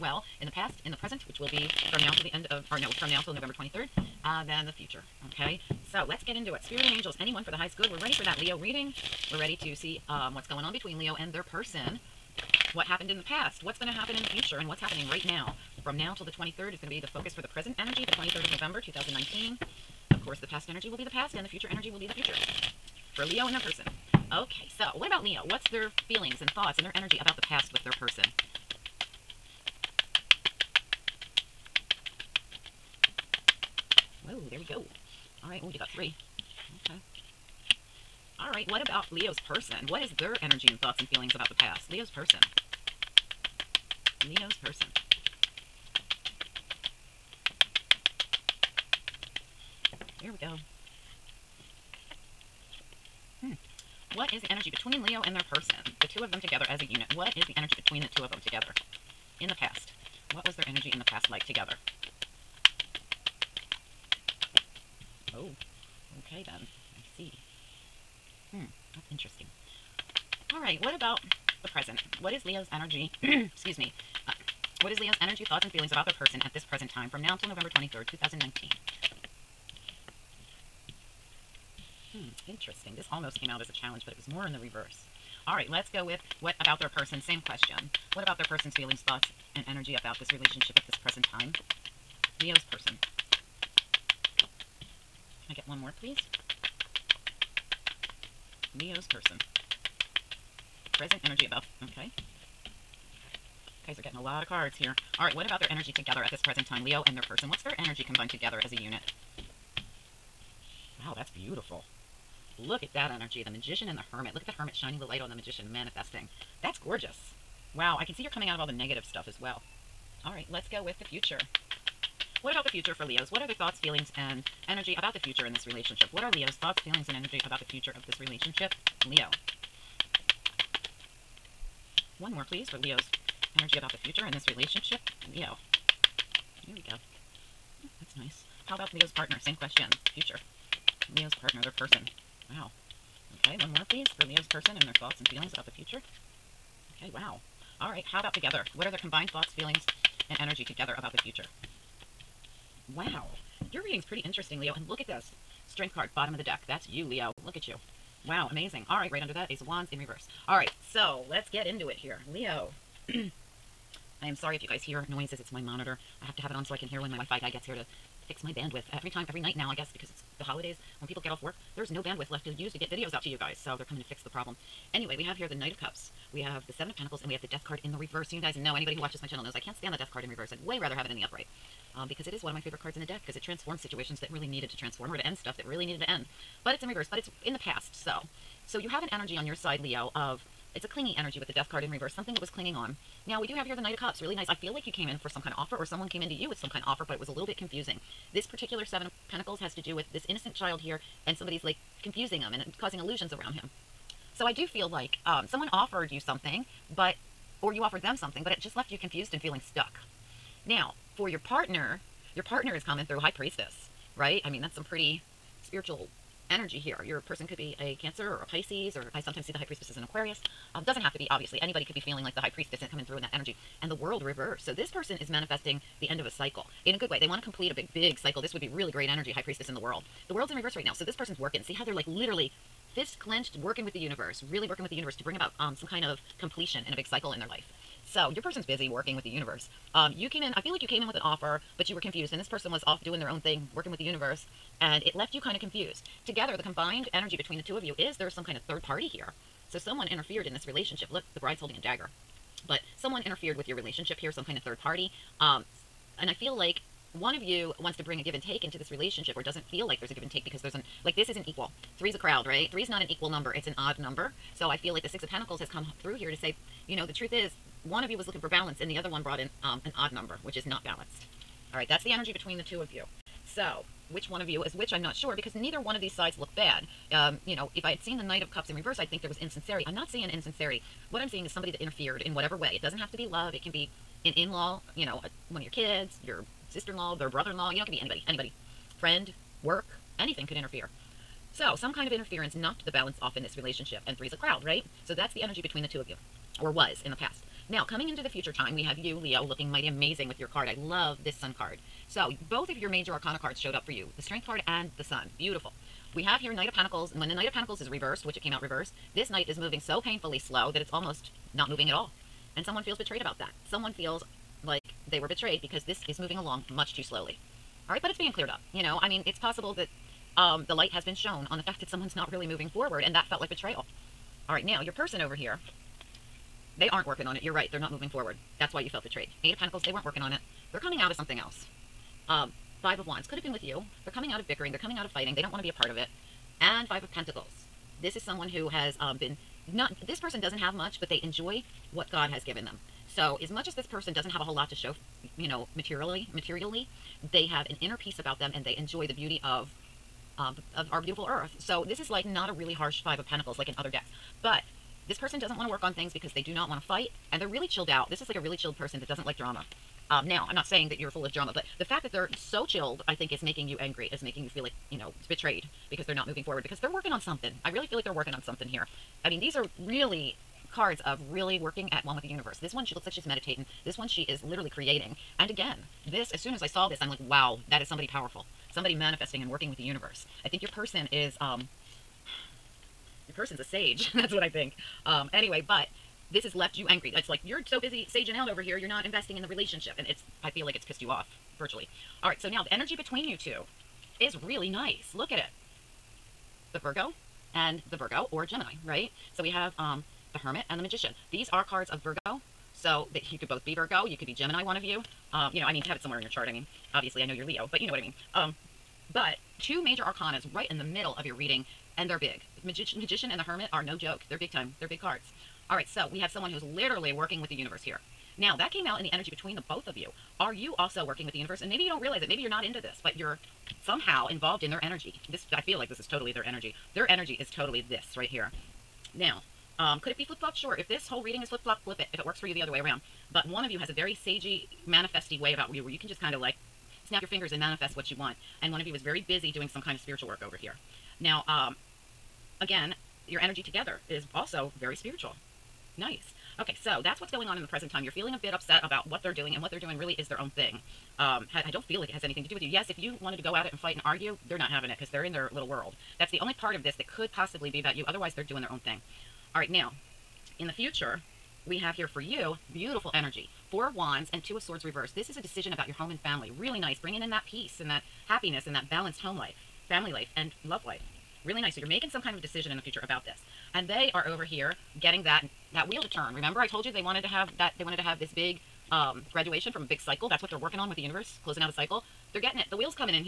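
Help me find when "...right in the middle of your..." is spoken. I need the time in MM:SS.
06:50.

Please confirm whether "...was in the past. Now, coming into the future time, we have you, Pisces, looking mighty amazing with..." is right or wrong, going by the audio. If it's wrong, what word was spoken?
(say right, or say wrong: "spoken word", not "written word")
wrong: "Leo", not "Pisces".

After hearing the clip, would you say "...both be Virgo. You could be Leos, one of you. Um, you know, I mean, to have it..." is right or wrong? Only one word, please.
wrong.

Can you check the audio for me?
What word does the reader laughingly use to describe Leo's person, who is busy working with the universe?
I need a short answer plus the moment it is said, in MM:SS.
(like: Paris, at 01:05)
A sage, at 06:23.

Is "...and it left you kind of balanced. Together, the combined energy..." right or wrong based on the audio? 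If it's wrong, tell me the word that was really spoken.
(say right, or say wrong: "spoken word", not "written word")
wrong: "confused", not "balanced".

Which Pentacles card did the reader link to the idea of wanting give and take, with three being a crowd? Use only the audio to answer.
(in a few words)
Six of Pentacles.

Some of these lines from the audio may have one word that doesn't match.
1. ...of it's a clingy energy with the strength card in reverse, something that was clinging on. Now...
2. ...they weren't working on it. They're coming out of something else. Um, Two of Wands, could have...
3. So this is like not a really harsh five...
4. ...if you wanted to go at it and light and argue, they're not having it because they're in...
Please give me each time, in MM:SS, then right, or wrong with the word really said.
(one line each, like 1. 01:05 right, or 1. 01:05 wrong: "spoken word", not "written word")
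1. 03:10 wrong: "death", not "strength"
2. 05:29 wrong: "Five", not "Two"
3. 05:51 right
4. 07:32 wrong: "fight", not "light".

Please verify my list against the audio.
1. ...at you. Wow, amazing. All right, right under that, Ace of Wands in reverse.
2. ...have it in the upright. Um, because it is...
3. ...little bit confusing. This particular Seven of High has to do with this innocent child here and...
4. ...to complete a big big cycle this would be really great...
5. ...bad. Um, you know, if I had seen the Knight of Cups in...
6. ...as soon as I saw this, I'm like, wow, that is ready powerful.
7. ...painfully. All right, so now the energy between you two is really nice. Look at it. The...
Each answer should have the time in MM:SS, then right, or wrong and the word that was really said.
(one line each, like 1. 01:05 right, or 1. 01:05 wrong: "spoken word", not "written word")
1. 02:37 right
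2. 03:00 right
3. 03:17 wrong: "Pentacles", not "High"
4. 03:47 right
5. 04:36 right
6. 06:16 wrong: "somebody", not "ready"
7. 06:31 wrong: "virtually", not "painfully".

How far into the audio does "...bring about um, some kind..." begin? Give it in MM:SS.
03:55.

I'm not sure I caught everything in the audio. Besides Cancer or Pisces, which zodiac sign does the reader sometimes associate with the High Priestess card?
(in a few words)
Aquarius.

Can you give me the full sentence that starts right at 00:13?
What's going to happen in the future.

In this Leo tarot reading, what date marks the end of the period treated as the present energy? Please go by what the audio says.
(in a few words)
November 23rd, 2019.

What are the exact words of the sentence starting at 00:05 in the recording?
Okay, so let's get into it.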